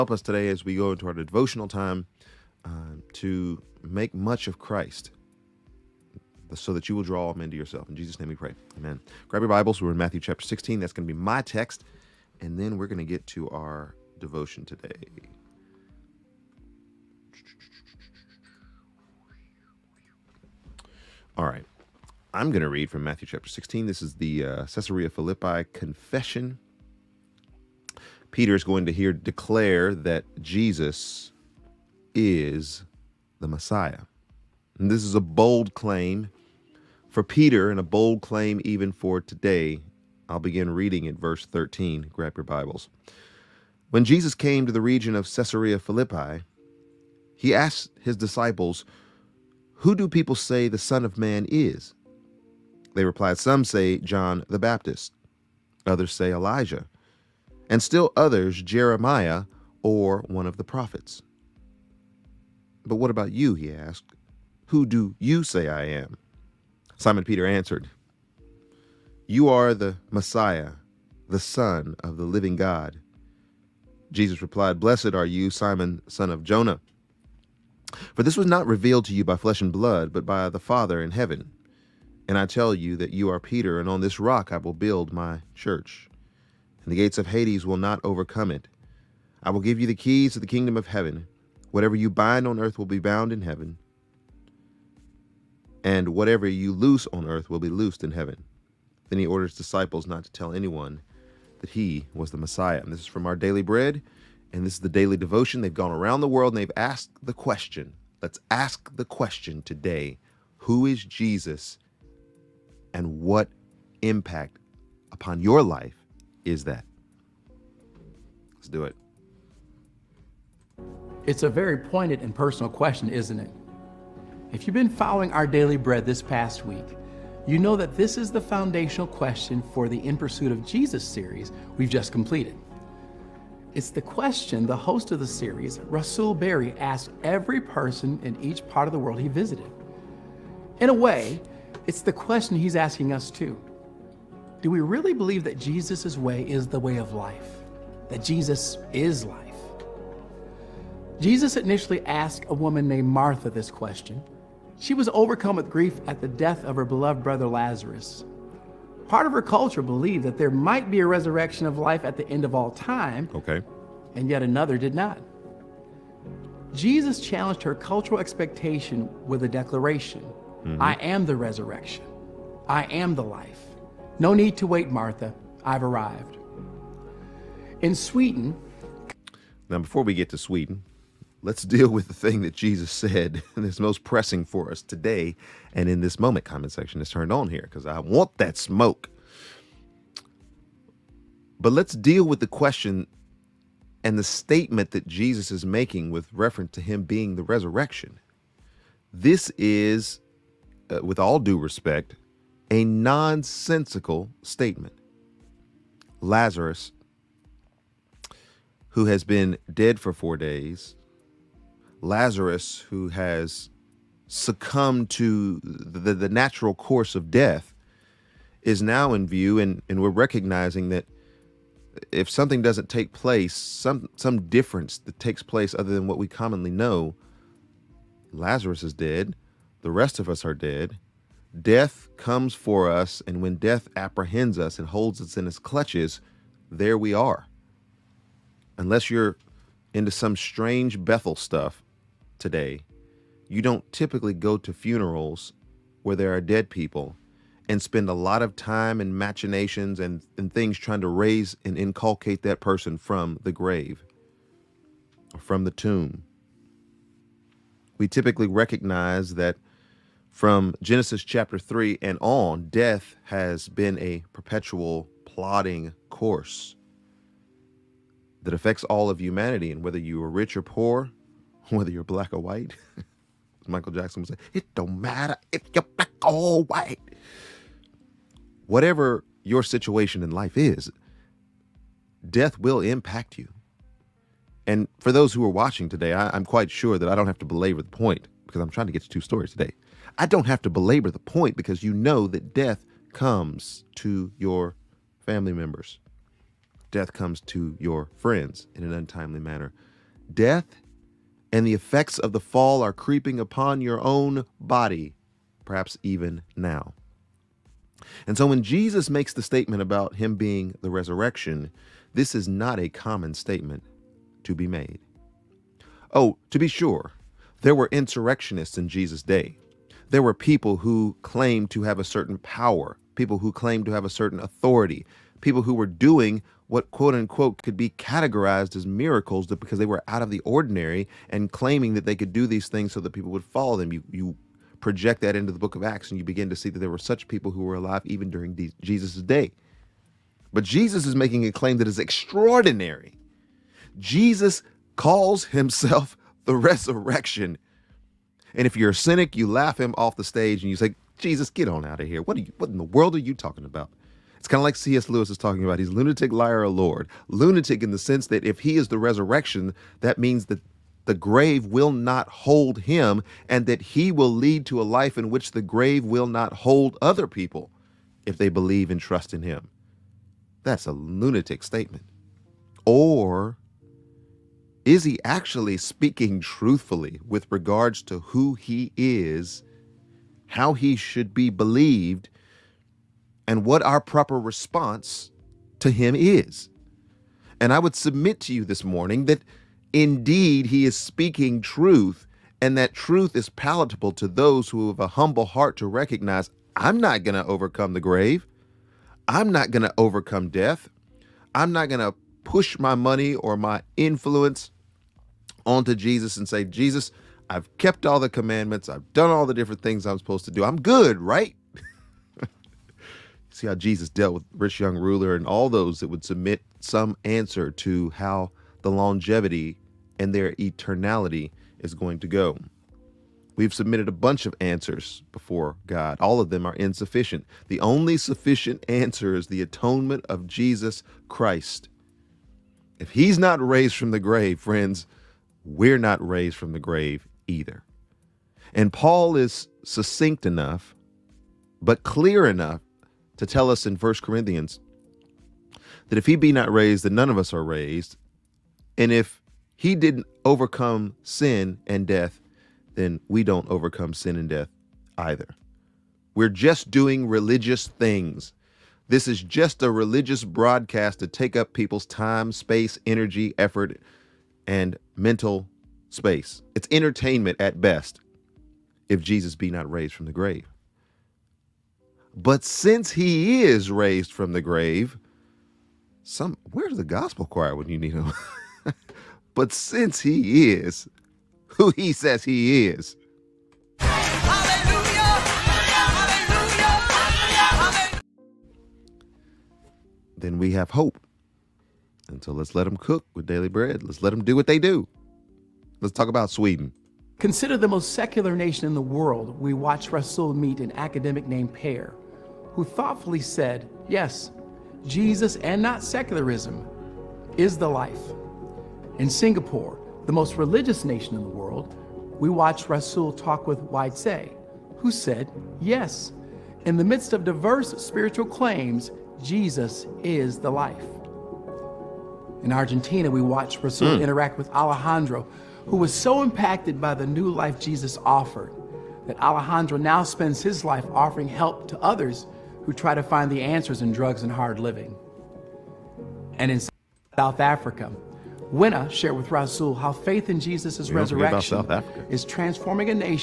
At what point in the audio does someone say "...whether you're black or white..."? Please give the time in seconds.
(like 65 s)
271 s.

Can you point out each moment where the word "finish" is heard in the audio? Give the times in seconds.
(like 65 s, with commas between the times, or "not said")
not said.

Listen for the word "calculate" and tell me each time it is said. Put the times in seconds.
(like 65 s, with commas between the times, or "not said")
not said.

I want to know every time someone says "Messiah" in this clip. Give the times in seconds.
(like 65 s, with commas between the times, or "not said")
33 s, 70 s, 102 s.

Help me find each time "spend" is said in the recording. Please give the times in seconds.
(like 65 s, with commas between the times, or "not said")
247 s, 530 s.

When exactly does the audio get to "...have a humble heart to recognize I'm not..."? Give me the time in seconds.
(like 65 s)
394 s.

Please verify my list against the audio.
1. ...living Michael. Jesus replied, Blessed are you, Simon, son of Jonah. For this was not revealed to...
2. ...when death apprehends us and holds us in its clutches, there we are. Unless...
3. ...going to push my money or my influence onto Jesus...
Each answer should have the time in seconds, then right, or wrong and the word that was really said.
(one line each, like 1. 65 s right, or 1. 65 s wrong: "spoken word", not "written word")
1. 72 s wrong: "God", not "Michael"
2. 233 s right
3. 401 s right.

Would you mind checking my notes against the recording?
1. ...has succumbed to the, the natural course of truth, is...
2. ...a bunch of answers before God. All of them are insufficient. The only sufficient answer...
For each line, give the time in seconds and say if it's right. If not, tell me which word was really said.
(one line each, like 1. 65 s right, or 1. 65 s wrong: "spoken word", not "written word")
1. 213 s wrong: "death", not "truth"
2. 424 s right.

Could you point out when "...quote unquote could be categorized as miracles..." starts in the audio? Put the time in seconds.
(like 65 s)
326 s.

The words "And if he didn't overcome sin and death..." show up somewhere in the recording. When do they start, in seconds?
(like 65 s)
448 s.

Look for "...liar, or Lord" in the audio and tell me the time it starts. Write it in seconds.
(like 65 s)
356 s.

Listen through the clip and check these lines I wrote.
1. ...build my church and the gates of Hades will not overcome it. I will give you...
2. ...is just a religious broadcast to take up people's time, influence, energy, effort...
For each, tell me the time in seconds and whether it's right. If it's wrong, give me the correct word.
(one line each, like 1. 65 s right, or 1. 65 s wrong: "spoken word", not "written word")
1. 84 s right
2. 459 s wrong: "space", not "influence".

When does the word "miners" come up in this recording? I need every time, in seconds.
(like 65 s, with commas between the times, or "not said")
not said.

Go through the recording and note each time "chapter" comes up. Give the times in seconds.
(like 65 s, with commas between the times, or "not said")
10 s, 23 s, 261 s.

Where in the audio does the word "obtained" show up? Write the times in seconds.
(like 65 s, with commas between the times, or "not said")
not said.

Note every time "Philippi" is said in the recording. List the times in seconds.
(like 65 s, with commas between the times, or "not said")
25 s, 45 s.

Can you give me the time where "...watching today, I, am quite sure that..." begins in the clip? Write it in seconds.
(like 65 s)
285 s.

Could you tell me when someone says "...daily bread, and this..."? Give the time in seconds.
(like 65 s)
103 s.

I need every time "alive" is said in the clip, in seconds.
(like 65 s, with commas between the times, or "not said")
337 s.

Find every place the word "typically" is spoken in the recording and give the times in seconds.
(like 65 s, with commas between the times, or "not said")
243 s, 258 s.